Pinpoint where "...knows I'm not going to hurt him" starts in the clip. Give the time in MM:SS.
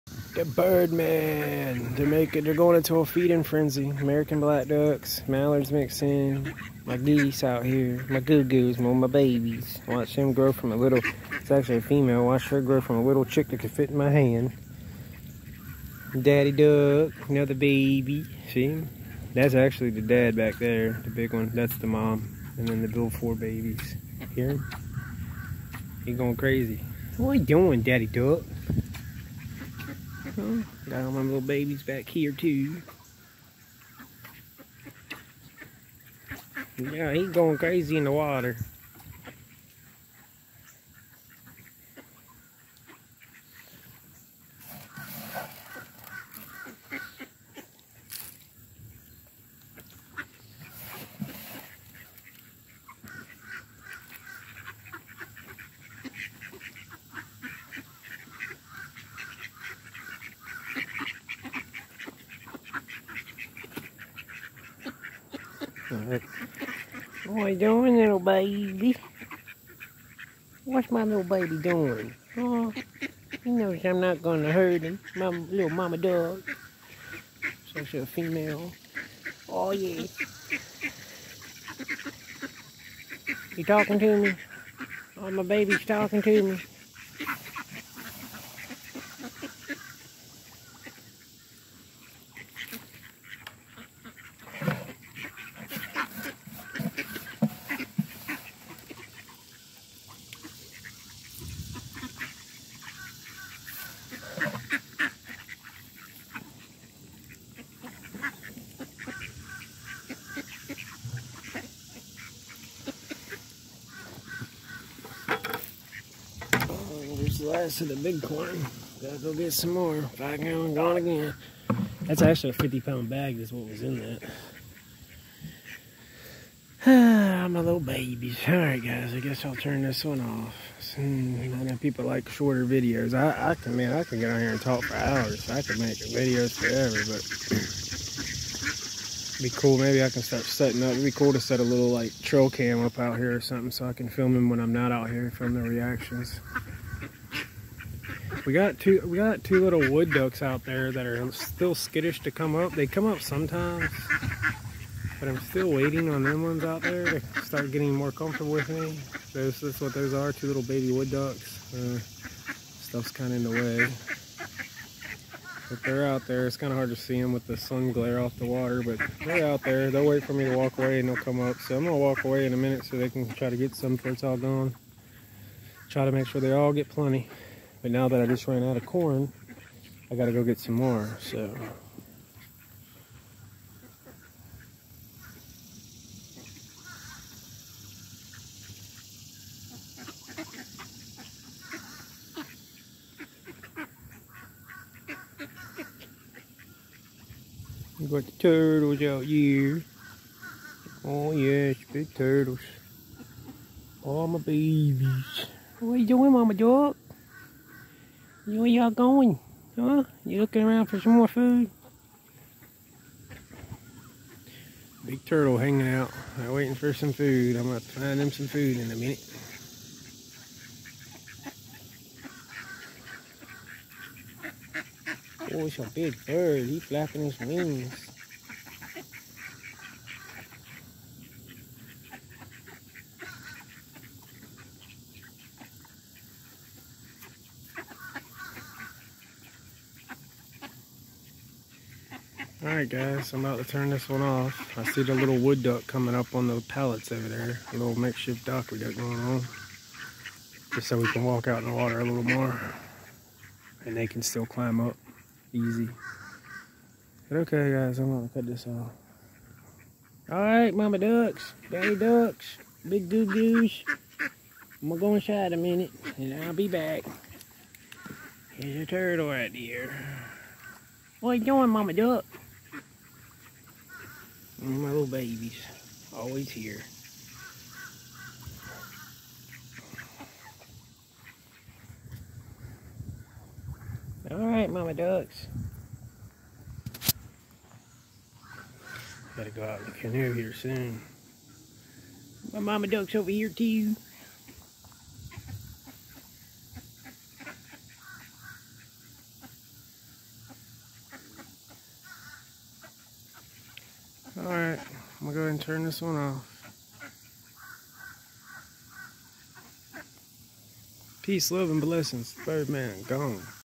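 01:13.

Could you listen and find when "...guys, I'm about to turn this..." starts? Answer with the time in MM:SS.
04:02.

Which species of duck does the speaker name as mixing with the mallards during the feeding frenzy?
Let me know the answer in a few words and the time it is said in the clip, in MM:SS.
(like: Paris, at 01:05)
American black ducks, at 00:03.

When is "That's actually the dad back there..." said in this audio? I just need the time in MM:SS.
00:19.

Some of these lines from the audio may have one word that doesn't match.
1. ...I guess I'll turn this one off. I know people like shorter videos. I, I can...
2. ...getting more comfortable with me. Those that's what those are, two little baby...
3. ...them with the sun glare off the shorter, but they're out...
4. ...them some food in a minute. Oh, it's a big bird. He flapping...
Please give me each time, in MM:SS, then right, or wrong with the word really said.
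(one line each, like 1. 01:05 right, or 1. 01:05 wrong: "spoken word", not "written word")
1. 02:09 right
2. 02:37 right
3. 02:47 wrong: "water", not "shorter"
4. 03:38 right.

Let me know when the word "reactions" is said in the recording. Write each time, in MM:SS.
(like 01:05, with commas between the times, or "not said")
02:25.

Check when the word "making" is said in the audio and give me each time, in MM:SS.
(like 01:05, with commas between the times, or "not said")
00:02.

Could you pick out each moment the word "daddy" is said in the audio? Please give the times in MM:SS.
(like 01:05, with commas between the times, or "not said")
00:16, 00:27, 04:21.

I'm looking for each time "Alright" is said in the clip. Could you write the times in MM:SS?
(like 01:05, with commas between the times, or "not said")
02:08, 04:02, 04:20, 05:04.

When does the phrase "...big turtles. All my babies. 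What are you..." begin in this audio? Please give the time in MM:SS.
03:21.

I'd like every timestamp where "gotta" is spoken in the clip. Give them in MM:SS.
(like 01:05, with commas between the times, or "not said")
01:59, 03:00, 04:49.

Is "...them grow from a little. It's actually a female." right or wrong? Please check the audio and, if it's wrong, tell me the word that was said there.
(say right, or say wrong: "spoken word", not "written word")
right.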